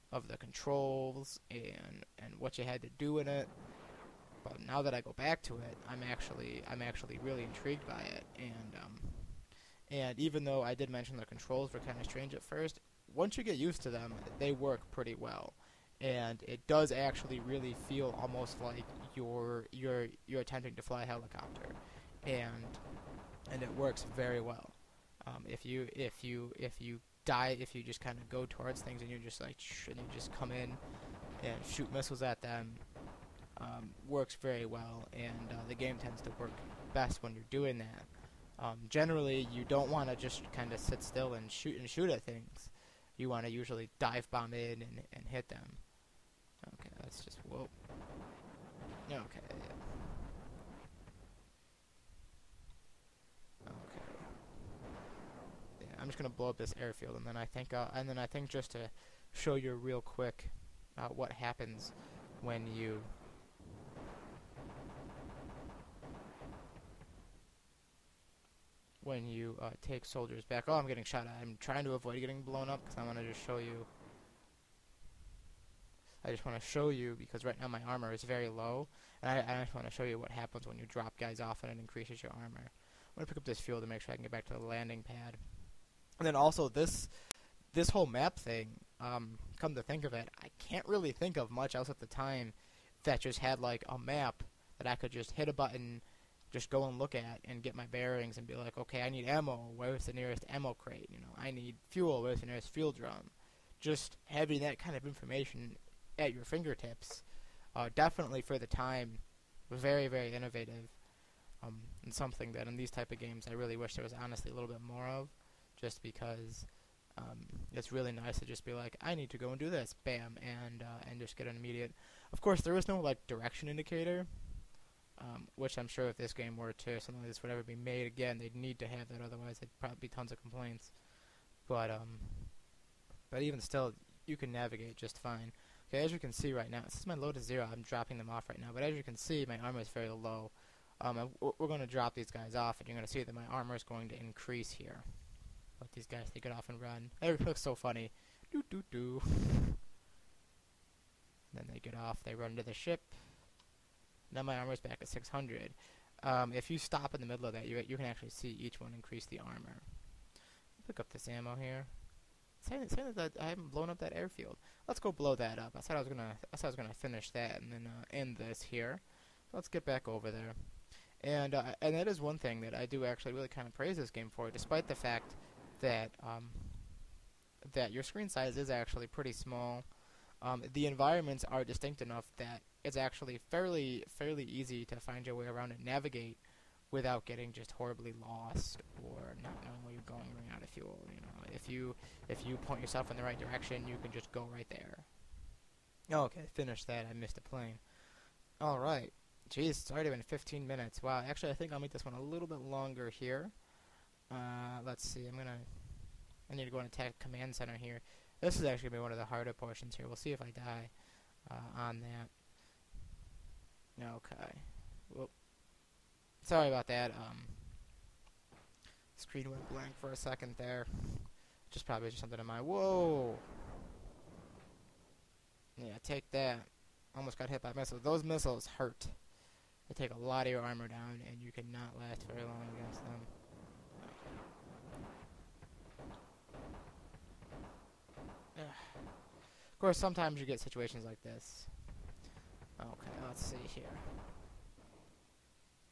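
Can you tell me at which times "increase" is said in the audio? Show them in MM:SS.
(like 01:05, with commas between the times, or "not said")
01:21, 02:24, 02:38.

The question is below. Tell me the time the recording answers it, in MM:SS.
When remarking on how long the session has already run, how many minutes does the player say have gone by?
03:20.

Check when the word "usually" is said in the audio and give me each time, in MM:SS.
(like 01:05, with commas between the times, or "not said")
00:43.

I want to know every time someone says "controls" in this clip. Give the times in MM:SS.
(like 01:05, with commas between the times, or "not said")
00:00, 00:11.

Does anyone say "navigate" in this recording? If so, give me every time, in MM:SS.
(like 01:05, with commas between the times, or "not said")
02:14, 03:05.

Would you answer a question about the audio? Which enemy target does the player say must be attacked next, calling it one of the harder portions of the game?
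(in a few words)
command center.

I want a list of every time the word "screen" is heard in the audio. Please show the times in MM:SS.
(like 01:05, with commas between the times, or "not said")
02:58, 03:39.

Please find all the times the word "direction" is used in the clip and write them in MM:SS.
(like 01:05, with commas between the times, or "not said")
02:03, 03:13.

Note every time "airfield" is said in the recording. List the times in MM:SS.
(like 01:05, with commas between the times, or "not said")
00:56, 02:44.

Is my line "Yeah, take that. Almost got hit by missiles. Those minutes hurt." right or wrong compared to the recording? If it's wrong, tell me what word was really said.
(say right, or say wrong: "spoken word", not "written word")
wrong: "missiles", not "minutes".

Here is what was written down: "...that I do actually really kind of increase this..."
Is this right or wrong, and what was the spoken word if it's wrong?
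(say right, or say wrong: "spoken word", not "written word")
wrong: "praise", not "increase".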